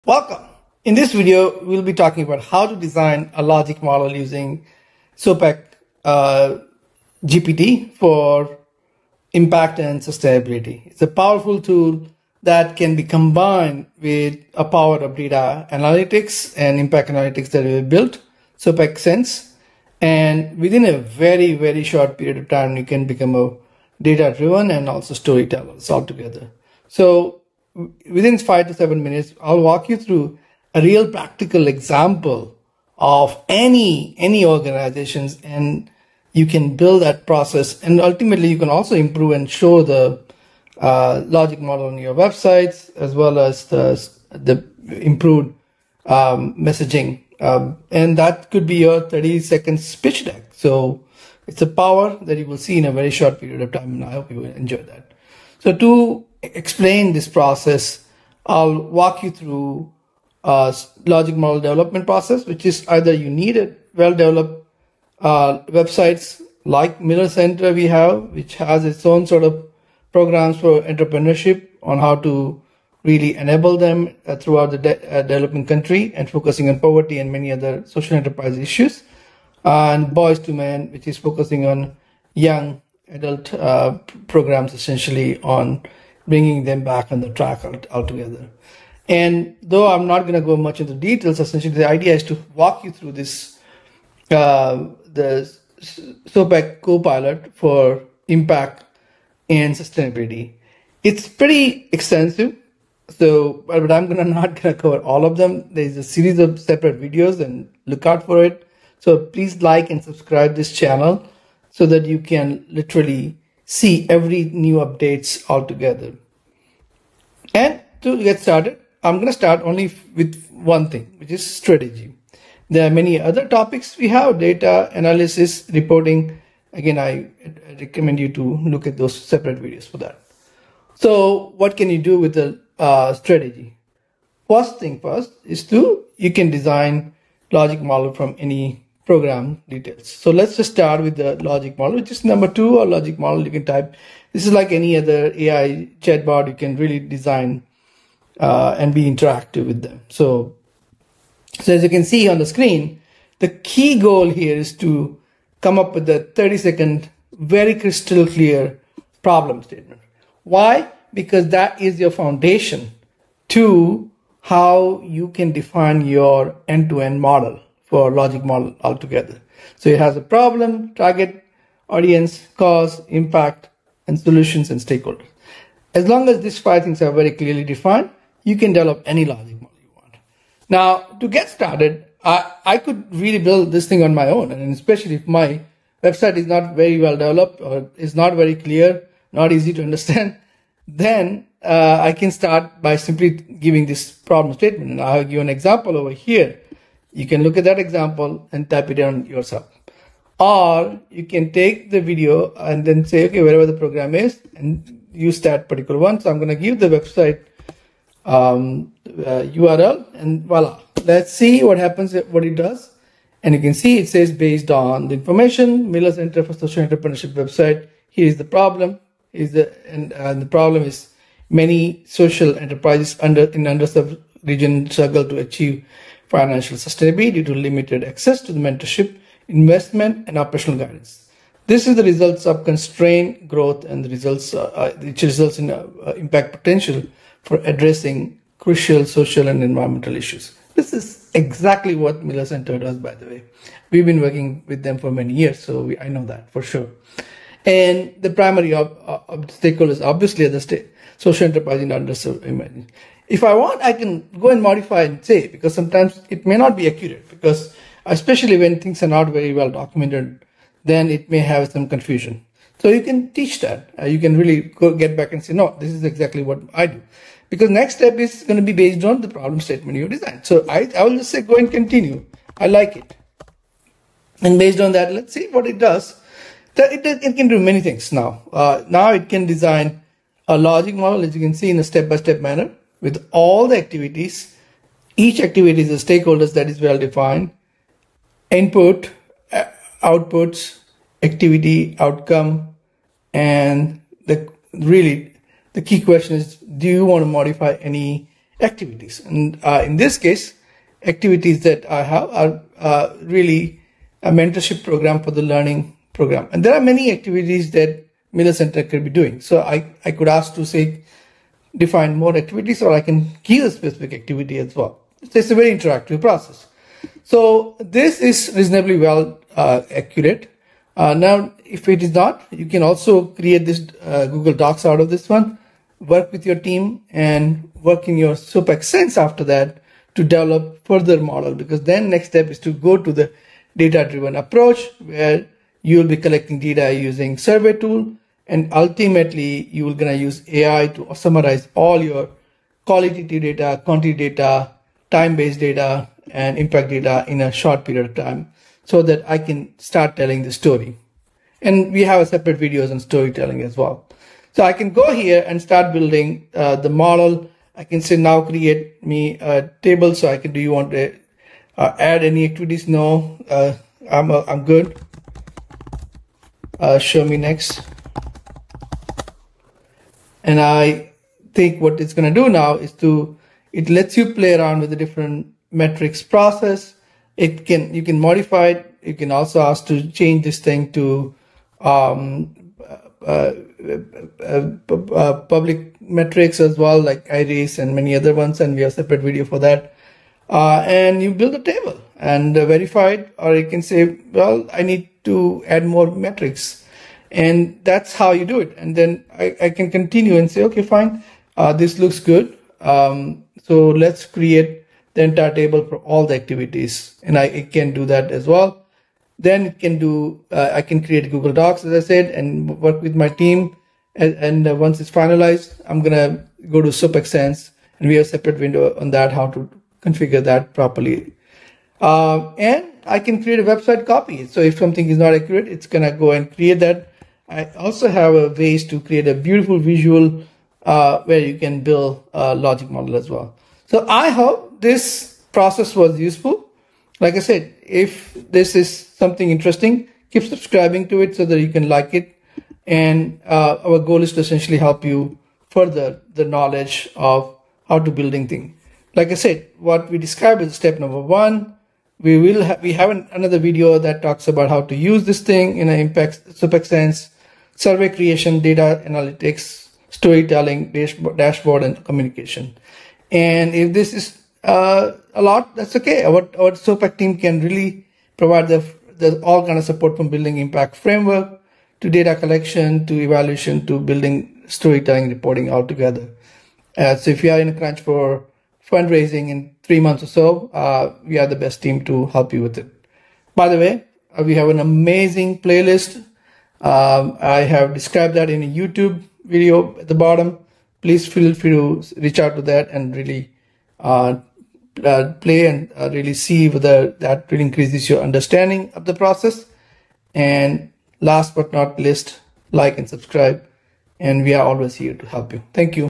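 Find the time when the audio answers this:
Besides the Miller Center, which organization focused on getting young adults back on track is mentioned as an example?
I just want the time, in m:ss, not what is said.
1:20.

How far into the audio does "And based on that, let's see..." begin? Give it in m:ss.
4:34.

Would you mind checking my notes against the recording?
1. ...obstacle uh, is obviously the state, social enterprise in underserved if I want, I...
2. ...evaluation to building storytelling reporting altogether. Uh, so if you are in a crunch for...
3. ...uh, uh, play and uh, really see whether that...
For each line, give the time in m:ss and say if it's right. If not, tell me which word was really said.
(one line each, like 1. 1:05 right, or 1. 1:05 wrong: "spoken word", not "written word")
1. 4:08 right
2. 7:53 right
3. 8:13 right.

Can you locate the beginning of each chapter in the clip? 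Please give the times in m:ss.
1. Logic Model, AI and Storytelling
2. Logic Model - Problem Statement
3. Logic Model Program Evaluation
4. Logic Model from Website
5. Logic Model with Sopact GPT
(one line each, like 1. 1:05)
1. 0:45
2. 2:26
3. 4:54
4. 3:23
5. 1:31.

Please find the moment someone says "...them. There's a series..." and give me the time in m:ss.
1:45.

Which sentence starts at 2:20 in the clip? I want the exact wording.
So let's just start with the logic model, which is number two or logic model.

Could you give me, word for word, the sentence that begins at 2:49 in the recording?
So it has a problem, target, audience, cause, impact, and solutions and stakeholders.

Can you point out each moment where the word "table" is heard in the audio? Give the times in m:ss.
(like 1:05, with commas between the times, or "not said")
5:59, 6:31, 6:45.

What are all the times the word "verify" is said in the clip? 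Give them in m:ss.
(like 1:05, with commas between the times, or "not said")
6:32.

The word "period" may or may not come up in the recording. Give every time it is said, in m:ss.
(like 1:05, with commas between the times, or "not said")
0:22, 0:53, 5:47.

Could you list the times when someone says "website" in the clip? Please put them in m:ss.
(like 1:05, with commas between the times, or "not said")
0:42, 1:05, 3:06, 3:26, 3:37, 7:03.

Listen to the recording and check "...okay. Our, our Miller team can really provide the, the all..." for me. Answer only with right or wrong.
wrong.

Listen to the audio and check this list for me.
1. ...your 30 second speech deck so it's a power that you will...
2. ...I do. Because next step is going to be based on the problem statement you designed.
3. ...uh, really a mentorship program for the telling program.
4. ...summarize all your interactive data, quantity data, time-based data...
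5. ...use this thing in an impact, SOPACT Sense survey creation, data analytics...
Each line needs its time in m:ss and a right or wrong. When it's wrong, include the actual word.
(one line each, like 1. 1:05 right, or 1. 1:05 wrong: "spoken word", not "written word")
1. 0:48 right
2. 4:26 right
3. 5:02 wrong: "learning", not "telling"
4. 5:41 wrong: "qualitative", not "interactive"
5. 7:34 right.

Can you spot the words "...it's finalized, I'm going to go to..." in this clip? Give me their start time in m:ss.
6:54.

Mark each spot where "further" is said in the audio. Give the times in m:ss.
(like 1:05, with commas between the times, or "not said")
5:30, 7:25.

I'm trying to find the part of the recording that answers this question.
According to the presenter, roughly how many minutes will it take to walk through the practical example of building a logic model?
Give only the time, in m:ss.
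0:28.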